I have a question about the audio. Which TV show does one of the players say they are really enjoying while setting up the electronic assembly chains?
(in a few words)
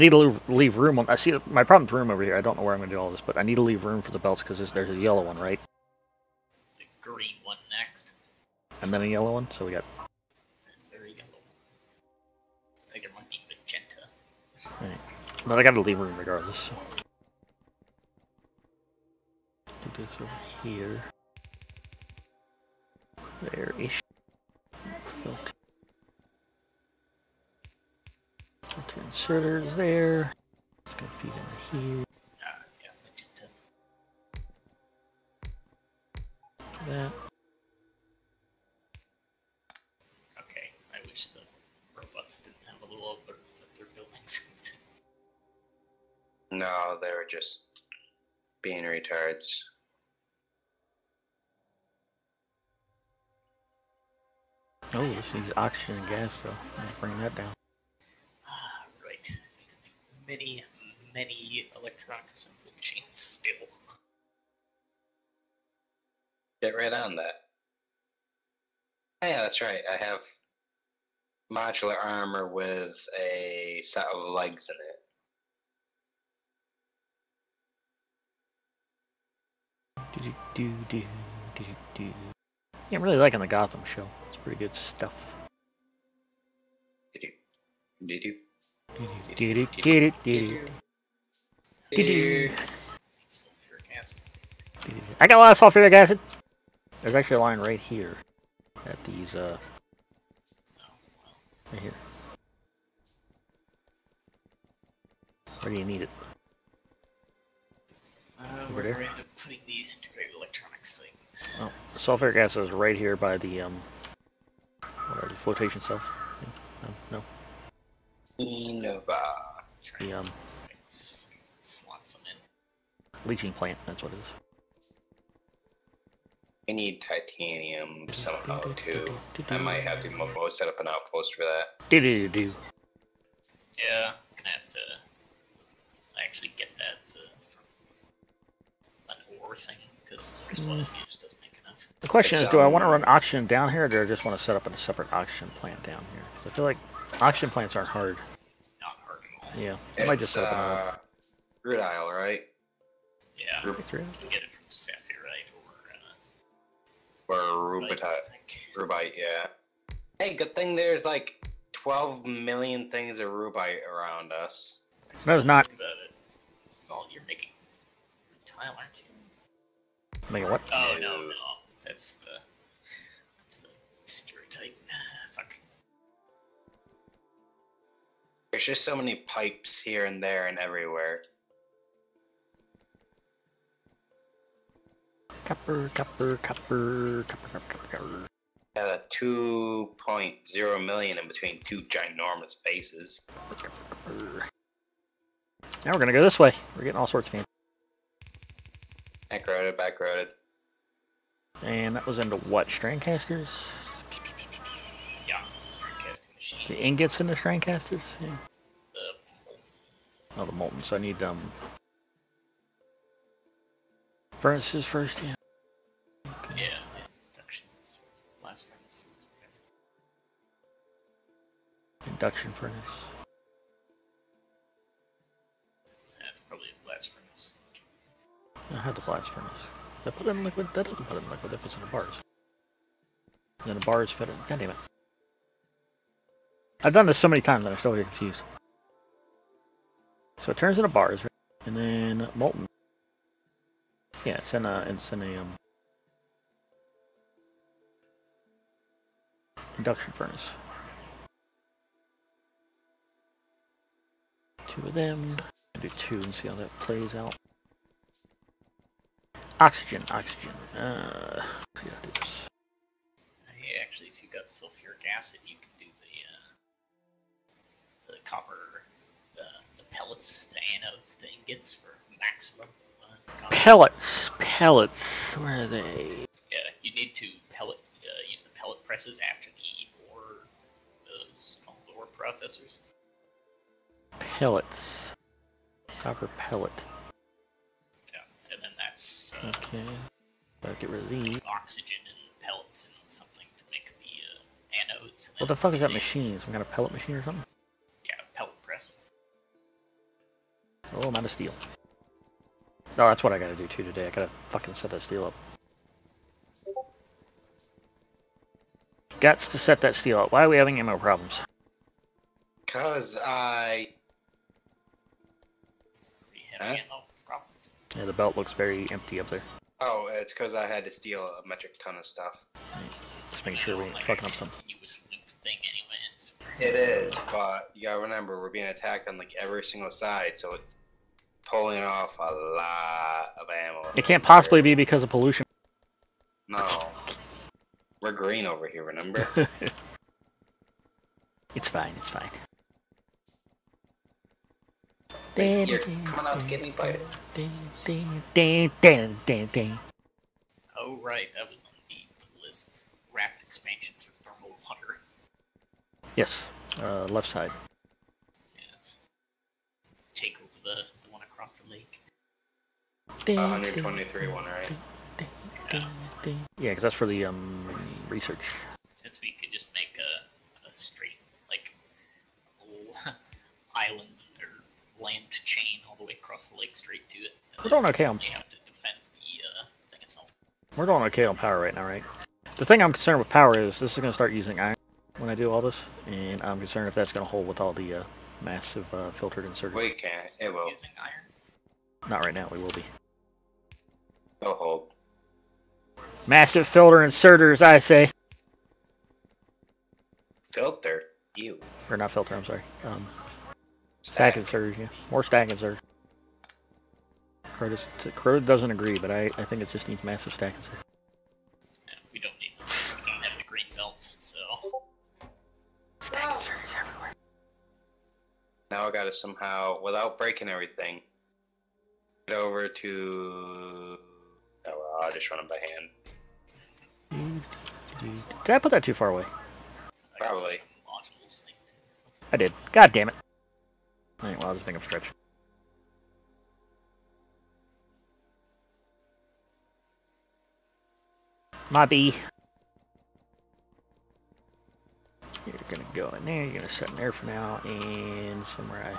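Gotham.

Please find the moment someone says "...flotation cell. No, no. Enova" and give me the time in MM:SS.
01:55.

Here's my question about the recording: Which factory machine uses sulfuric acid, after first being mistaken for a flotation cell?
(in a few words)
Leaching plant.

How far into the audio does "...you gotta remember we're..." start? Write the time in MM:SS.
05:27.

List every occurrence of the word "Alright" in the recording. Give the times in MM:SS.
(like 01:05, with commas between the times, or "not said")
07:14.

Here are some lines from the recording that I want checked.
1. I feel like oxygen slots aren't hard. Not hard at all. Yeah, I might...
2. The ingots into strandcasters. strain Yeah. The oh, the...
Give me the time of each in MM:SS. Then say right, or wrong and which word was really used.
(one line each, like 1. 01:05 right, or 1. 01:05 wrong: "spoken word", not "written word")
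1. 02:26 wrong: "plants", not "slots"
2. 03:26 right.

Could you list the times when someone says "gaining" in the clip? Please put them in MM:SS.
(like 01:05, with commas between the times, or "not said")
not said.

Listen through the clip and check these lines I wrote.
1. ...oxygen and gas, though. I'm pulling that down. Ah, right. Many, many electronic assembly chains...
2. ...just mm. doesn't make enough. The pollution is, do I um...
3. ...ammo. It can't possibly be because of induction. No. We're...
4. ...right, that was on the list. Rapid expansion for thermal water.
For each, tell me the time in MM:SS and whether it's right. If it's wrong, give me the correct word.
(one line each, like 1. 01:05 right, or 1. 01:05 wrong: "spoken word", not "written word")
1. 00:55 wrong: "bring", not "pulling"
2. 02:20 wrong: "question", not "pollution"
3. 05:33 wrong: "pollution", not "induction"
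4. 05:51 right.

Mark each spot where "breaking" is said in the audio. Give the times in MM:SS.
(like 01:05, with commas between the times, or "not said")
07:00.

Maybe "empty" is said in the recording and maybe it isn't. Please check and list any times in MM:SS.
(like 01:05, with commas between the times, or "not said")
05:18.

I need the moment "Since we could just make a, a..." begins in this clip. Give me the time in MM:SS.
06:08.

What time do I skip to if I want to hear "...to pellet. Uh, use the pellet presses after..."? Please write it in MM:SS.
04:37.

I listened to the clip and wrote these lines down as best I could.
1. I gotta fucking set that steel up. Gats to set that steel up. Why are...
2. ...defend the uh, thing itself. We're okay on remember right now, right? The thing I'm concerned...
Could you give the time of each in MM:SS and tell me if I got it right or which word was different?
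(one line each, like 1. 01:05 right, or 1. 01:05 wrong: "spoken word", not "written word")
1. 05:04 right
2. 06:18 wrong: "power", not "remember".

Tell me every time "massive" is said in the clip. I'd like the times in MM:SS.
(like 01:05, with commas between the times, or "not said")
06:28, 06:36, 06:50.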